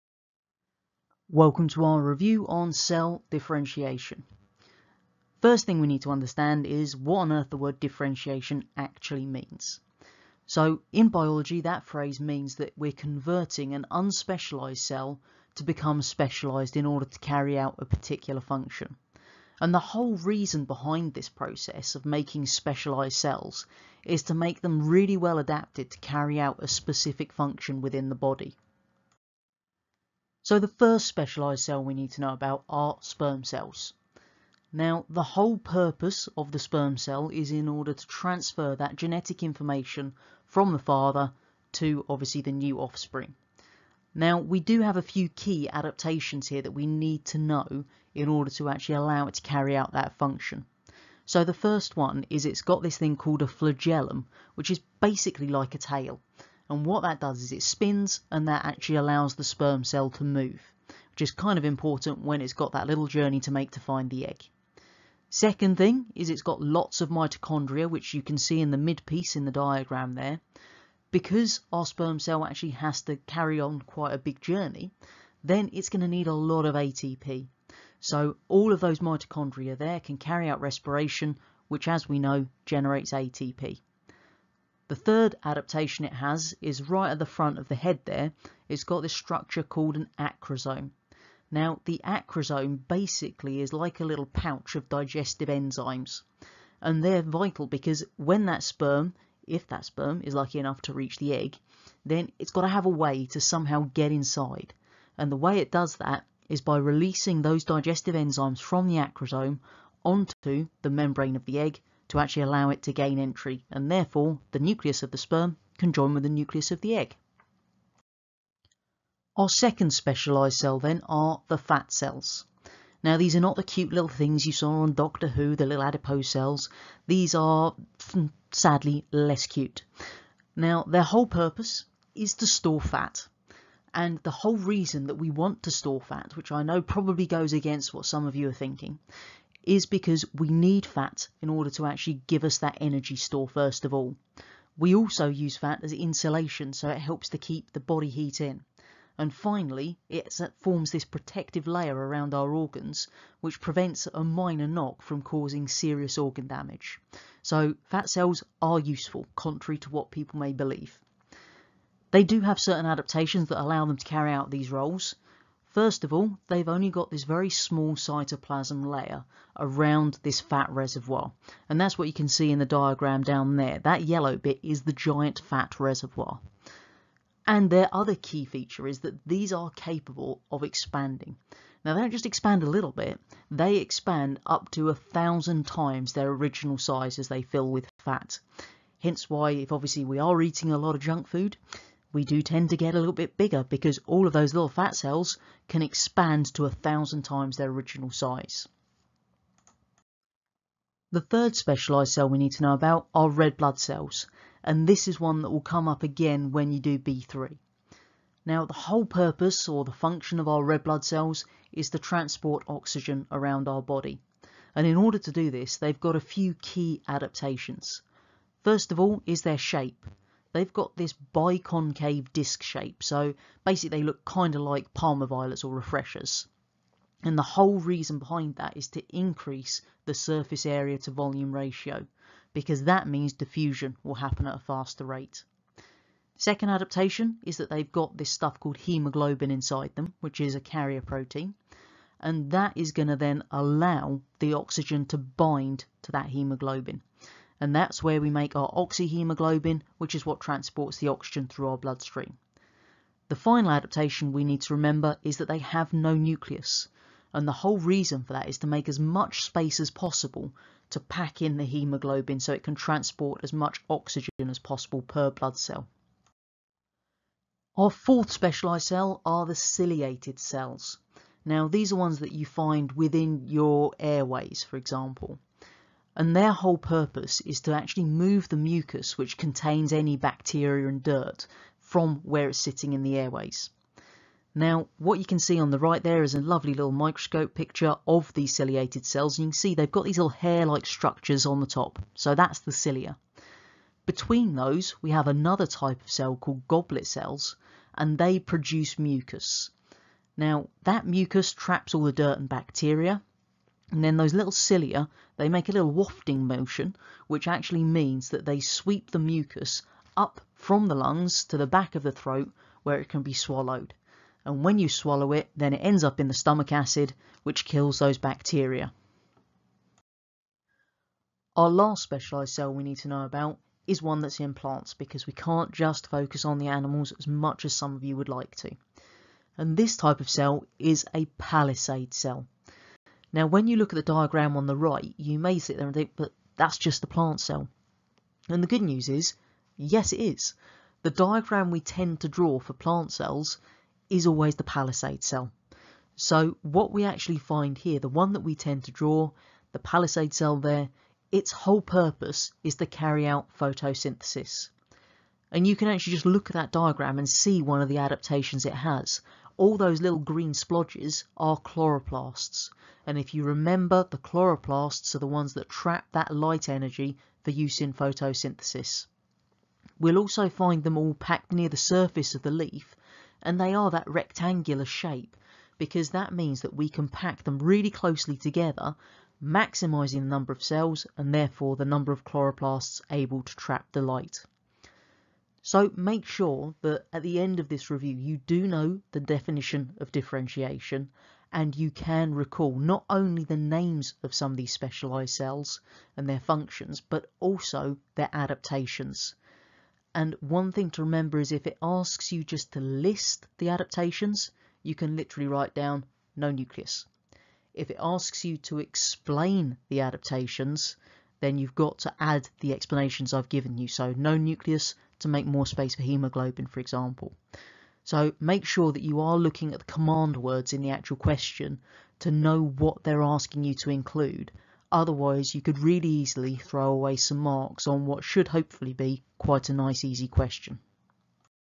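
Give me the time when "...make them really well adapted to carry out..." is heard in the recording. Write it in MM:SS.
00:24.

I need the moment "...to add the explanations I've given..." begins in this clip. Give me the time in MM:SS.
06:51.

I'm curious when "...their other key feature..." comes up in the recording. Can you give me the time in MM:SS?
02:57.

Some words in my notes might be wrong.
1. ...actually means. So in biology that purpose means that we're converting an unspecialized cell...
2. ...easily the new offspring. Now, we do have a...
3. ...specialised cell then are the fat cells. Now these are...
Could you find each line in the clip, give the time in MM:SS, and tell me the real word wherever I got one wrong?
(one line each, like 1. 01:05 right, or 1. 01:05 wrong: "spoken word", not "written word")
1. 00:08 wrong: "phrase", not "purpose"
2. 00:42 wrong: "obviously", not "easily"
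3. 01:59 right.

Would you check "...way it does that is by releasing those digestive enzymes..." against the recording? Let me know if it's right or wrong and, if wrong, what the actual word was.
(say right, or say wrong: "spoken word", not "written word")
right.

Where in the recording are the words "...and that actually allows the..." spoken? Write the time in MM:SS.
00:58.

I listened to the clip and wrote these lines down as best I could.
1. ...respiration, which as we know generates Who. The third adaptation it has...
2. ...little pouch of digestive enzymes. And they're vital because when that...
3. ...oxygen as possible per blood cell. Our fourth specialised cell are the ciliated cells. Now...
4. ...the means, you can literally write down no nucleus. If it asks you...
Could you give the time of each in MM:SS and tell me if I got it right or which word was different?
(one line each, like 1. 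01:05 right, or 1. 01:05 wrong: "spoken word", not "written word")
1. 01:20 wrong: "ATP", not "Who"
2. 01:34 right
3. 04:23 right
4. 06:43 wrong: "adaptations", not "means".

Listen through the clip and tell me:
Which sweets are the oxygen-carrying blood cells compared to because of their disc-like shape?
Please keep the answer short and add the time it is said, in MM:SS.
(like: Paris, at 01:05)
Parma violets or refreshers, at 03:44.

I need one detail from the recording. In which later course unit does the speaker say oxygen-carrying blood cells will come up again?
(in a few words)
B3.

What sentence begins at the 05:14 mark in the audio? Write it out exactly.
And when you swallow it, then it ends up in the stomach acid, which kills those bacteria.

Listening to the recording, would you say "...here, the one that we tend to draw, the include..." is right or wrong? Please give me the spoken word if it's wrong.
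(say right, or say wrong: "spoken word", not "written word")
wrong: "palisade", not "include".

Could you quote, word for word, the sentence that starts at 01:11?
Because our sperm cell actually has to carry on quite a big journey, then it's going to need a lot of ATP.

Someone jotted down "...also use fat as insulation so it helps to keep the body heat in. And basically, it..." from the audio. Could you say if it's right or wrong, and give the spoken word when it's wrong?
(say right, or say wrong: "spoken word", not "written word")
wrong: "finally", not "basically".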